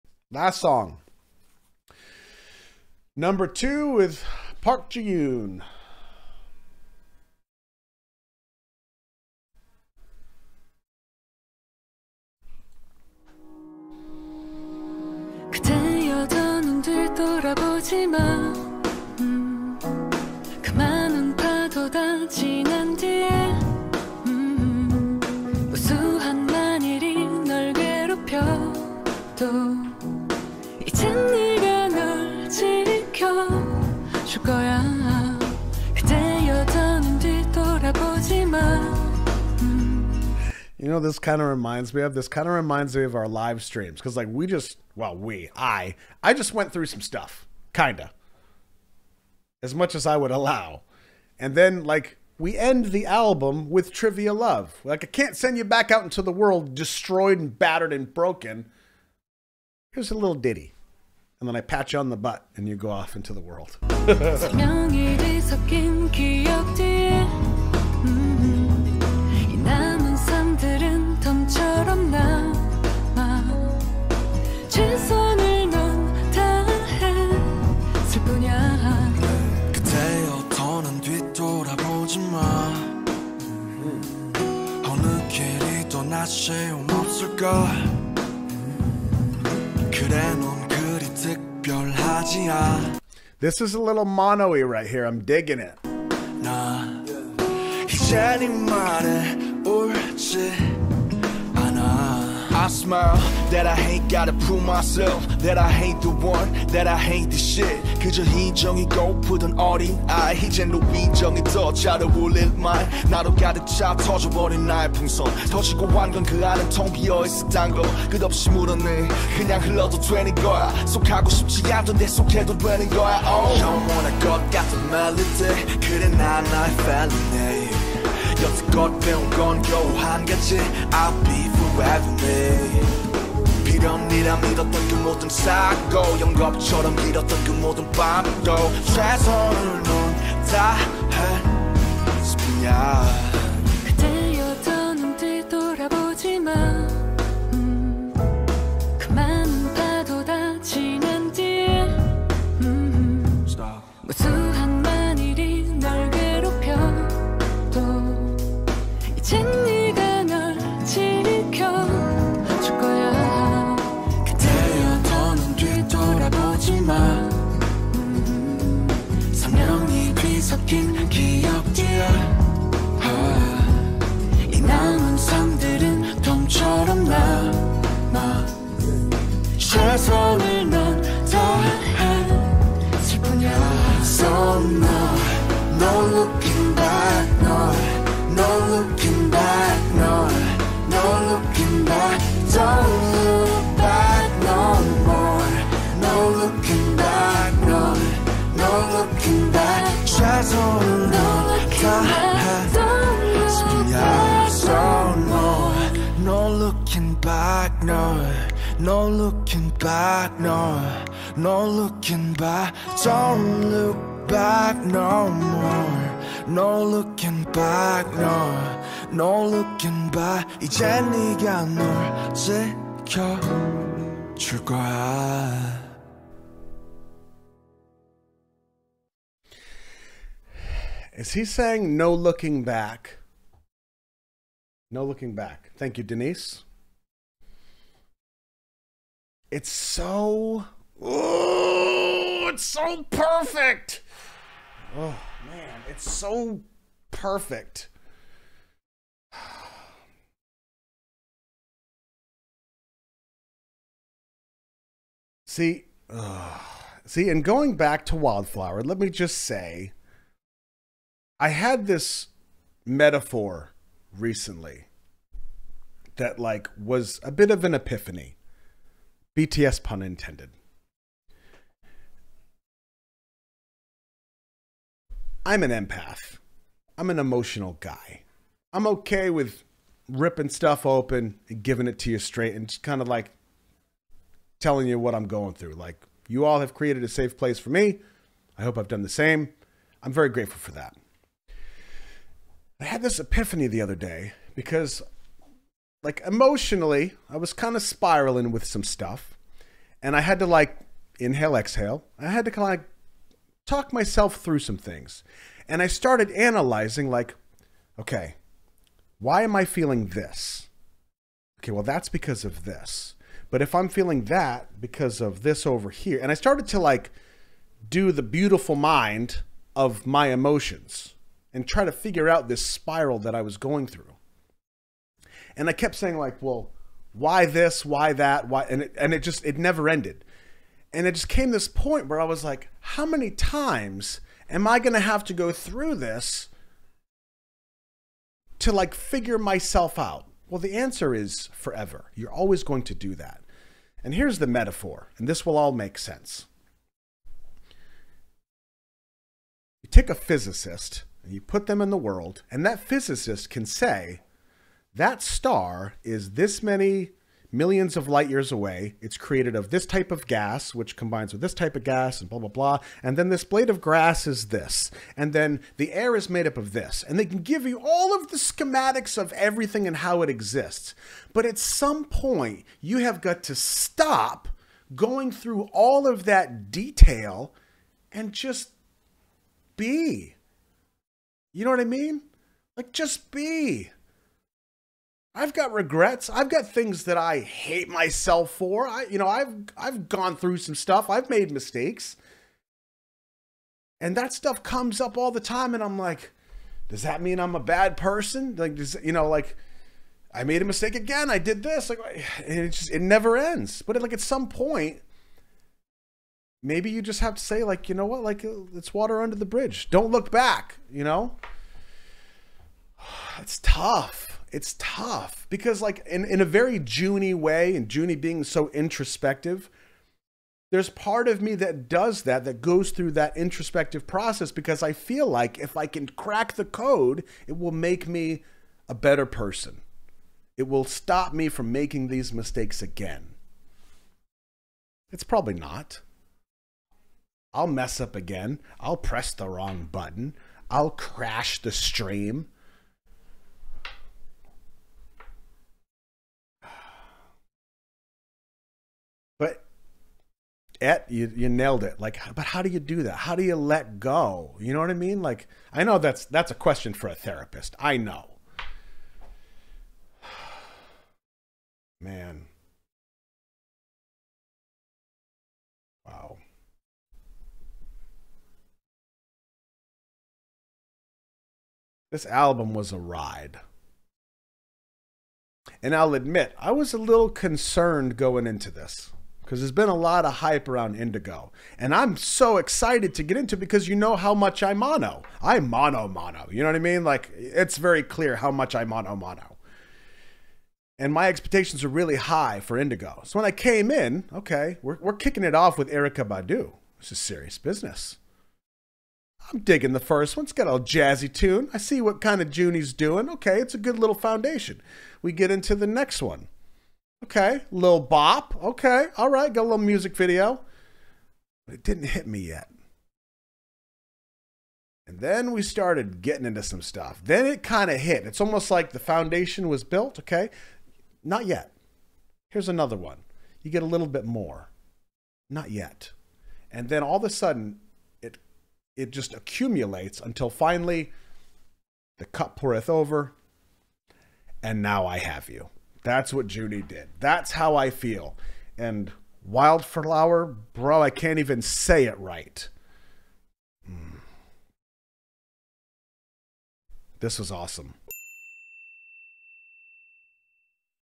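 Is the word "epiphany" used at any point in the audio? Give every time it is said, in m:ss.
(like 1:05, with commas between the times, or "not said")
4:27, 4:53.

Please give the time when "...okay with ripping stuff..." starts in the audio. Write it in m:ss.
4:38.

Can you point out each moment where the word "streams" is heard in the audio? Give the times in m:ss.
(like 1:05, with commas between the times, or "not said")
0:43, 7:21.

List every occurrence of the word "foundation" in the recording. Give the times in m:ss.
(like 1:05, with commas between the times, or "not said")
8:24, 8:38.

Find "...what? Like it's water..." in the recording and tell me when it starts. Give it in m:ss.
6:48.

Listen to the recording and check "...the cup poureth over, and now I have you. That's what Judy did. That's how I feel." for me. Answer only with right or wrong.
right.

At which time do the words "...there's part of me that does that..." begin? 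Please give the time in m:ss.
7:00.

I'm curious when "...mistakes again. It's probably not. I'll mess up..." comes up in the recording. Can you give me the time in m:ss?
7:12.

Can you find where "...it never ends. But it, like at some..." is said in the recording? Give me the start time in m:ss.
6:42.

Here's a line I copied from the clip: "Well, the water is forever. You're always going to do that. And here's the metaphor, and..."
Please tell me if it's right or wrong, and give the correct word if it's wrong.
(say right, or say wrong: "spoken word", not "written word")
wrong: "answer", not "water".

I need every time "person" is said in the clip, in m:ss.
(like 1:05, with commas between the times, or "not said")
6:37, 7:09.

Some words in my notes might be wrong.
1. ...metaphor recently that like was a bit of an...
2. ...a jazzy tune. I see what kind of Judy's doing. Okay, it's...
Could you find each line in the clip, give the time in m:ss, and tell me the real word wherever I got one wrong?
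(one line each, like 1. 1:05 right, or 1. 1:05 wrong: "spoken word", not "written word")
1. 4:22 right
2. 8:20 wrong: "Joonie", not "Judy".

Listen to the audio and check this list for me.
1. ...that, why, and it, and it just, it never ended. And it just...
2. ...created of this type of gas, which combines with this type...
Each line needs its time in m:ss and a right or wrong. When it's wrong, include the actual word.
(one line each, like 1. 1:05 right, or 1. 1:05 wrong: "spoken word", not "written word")
1. 5:28 right
2. 5:59 right.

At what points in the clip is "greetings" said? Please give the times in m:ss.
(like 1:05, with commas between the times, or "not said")
not said.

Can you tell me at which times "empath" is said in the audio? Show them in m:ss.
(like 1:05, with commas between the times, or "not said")
4:35.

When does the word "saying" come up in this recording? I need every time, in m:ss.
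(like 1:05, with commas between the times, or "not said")
3:51, 5:25.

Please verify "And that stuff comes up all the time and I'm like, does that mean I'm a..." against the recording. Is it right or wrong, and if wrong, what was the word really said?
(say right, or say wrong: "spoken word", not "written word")
right.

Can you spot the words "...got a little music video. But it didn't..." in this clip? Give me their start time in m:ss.
8:29.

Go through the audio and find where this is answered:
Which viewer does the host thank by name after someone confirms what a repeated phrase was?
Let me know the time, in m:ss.
3:56.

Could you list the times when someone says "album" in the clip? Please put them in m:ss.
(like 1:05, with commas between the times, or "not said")
0:53, 7:52.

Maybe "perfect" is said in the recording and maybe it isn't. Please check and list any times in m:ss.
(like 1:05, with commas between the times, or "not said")
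4:03, 4:07.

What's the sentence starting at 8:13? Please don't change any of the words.
So when I came in, okay, we're, we're kicking it off with Erykah Badu.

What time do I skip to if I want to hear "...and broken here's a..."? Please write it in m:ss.
0:57.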